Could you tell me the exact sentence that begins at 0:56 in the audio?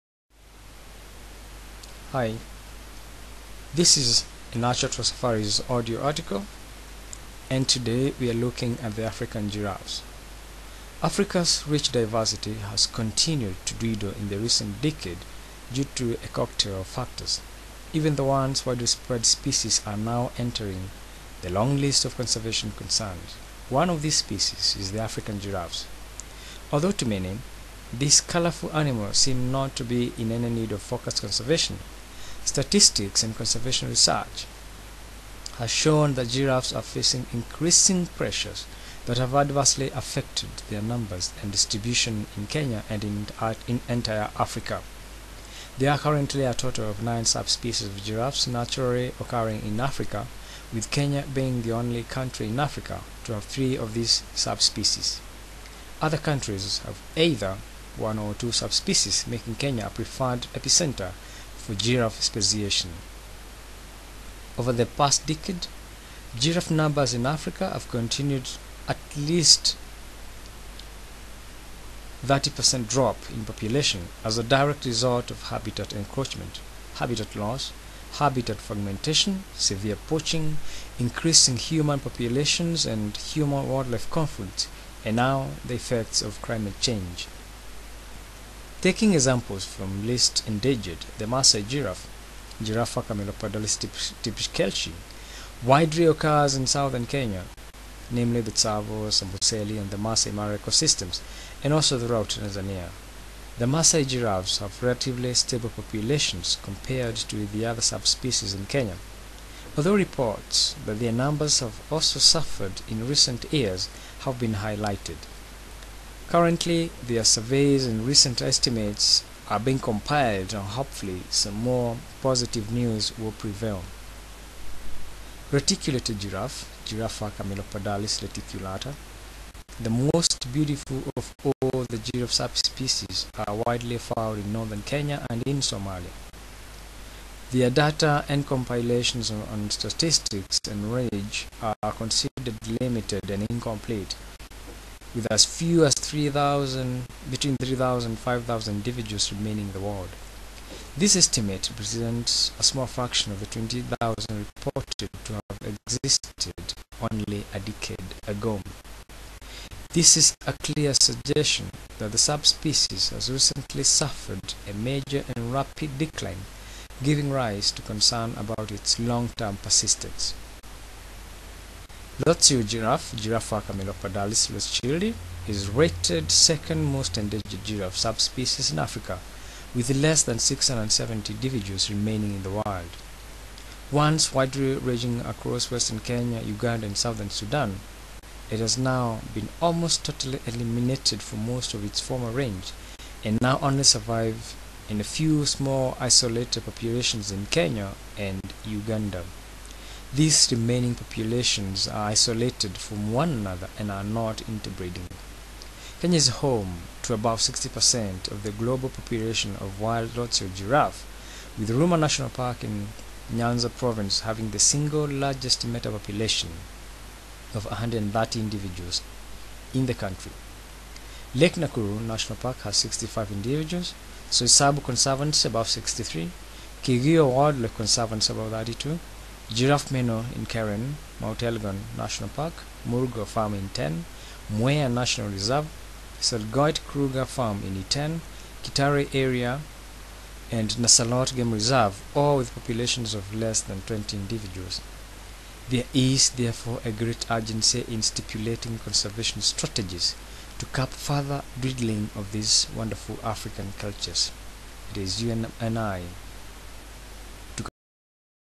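Other countries have either one or two subspecies, making Kenya a preferred epicenter for giraffe speciation.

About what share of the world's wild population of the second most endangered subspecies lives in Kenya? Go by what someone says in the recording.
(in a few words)
60%.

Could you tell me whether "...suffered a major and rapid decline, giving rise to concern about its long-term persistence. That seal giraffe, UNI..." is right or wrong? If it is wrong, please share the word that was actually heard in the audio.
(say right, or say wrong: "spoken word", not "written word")
wrong: "Giraffa", not "UNI".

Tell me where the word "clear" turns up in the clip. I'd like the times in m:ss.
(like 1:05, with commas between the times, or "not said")
2:40.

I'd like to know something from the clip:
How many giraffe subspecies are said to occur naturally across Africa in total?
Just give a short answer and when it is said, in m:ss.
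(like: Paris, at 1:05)
9, at 0:47.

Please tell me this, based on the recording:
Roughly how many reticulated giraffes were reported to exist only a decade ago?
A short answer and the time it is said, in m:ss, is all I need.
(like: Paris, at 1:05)
20,000, at 2:33.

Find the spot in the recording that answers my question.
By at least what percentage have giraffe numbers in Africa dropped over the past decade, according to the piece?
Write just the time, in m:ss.
1:12.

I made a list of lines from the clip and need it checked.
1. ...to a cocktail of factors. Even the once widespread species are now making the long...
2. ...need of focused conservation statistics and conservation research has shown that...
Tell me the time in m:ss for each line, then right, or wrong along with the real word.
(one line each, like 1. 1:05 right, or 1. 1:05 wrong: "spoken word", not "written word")
1. 0:15 wrong: "entering", not "making"
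2. 0:30 right.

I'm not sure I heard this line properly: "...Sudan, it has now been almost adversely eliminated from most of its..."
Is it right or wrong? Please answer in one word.
wrong.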